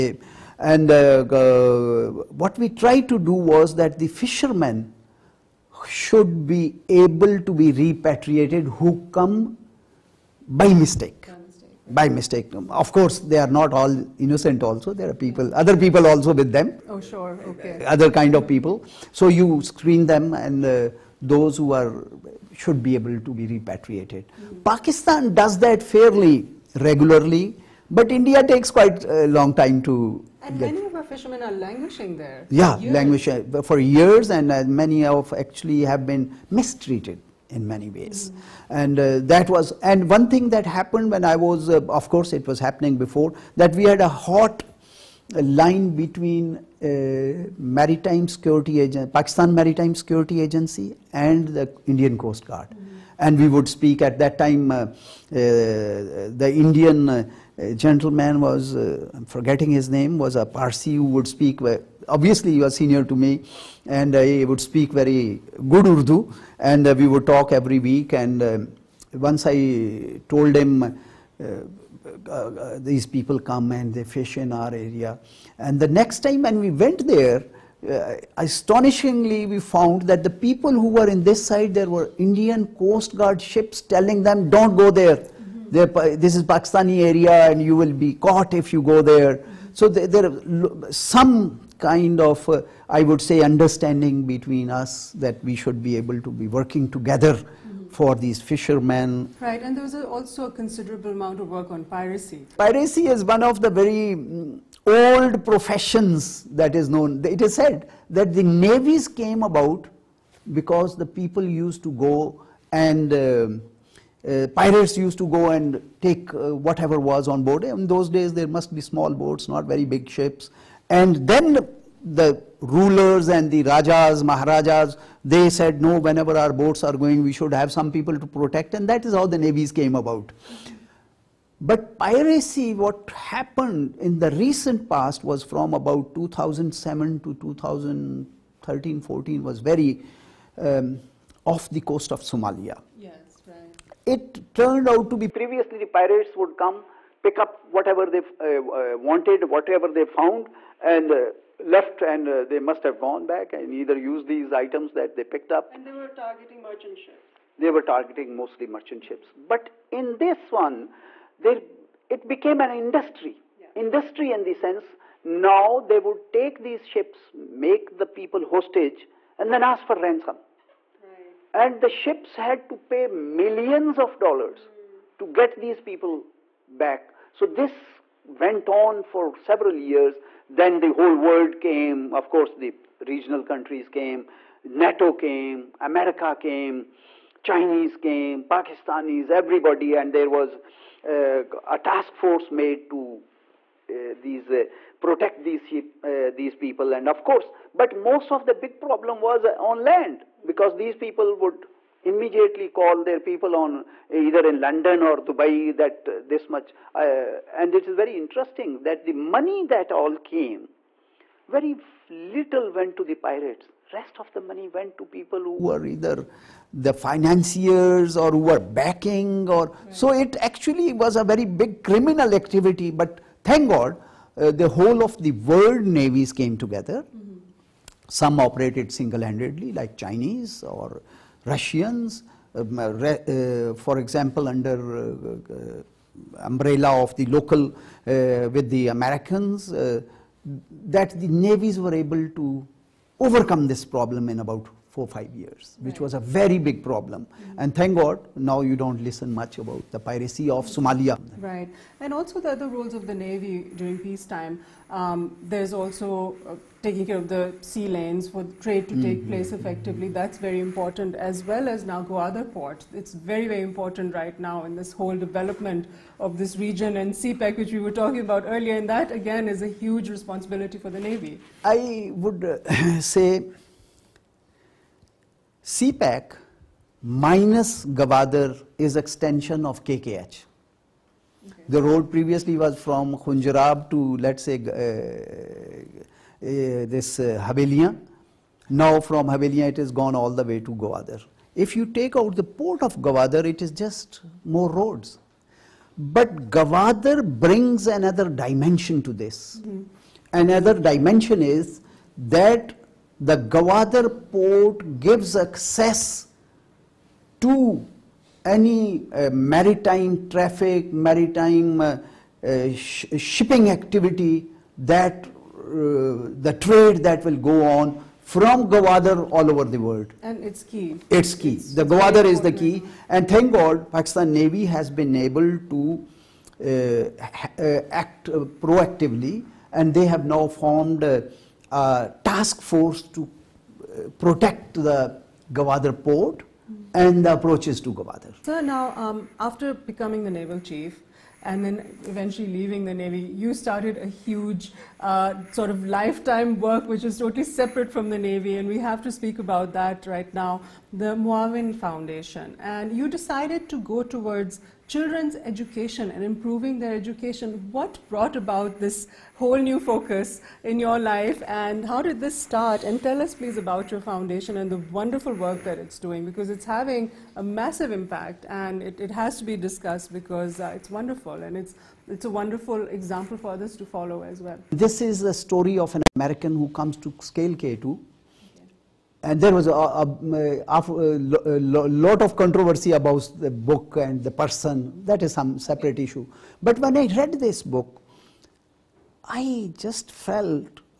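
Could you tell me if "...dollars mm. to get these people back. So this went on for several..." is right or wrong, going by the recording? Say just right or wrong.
right.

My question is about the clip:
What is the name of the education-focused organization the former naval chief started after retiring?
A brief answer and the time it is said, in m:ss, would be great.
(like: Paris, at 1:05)
Moawin Foundation, at 5:51.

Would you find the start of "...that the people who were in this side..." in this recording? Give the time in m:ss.
1:20.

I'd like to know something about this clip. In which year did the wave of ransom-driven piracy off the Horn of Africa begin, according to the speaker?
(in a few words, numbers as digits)
2007.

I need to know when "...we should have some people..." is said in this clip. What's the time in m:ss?
2:07.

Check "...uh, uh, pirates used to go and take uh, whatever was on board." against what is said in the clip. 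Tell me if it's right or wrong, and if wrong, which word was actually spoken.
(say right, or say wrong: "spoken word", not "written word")
right.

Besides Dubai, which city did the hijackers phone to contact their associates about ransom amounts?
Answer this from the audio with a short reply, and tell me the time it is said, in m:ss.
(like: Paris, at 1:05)
London, at 3:24.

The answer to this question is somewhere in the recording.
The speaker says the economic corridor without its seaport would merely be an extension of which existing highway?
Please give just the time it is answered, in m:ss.
4:39.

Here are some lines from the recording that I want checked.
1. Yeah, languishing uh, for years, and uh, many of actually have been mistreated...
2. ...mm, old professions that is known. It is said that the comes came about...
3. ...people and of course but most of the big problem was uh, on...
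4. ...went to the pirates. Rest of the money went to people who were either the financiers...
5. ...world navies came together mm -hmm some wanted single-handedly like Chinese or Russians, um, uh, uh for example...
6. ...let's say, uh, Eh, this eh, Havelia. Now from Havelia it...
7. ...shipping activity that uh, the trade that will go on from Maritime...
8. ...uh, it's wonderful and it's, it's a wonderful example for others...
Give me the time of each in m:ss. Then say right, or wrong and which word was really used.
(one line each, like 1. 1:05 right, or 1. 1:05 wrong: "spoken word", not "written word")
1. 0:32 right
2. 1:44 wrong: "navies", not "comes"
3. 3:16 right
4. 3:32 right
5. 3:45 wrong: "operated", not "wanted"
6. 4:44 right
7. 5:13 wrong: "Gwadar", not "Maritime"
8. 6:10 right.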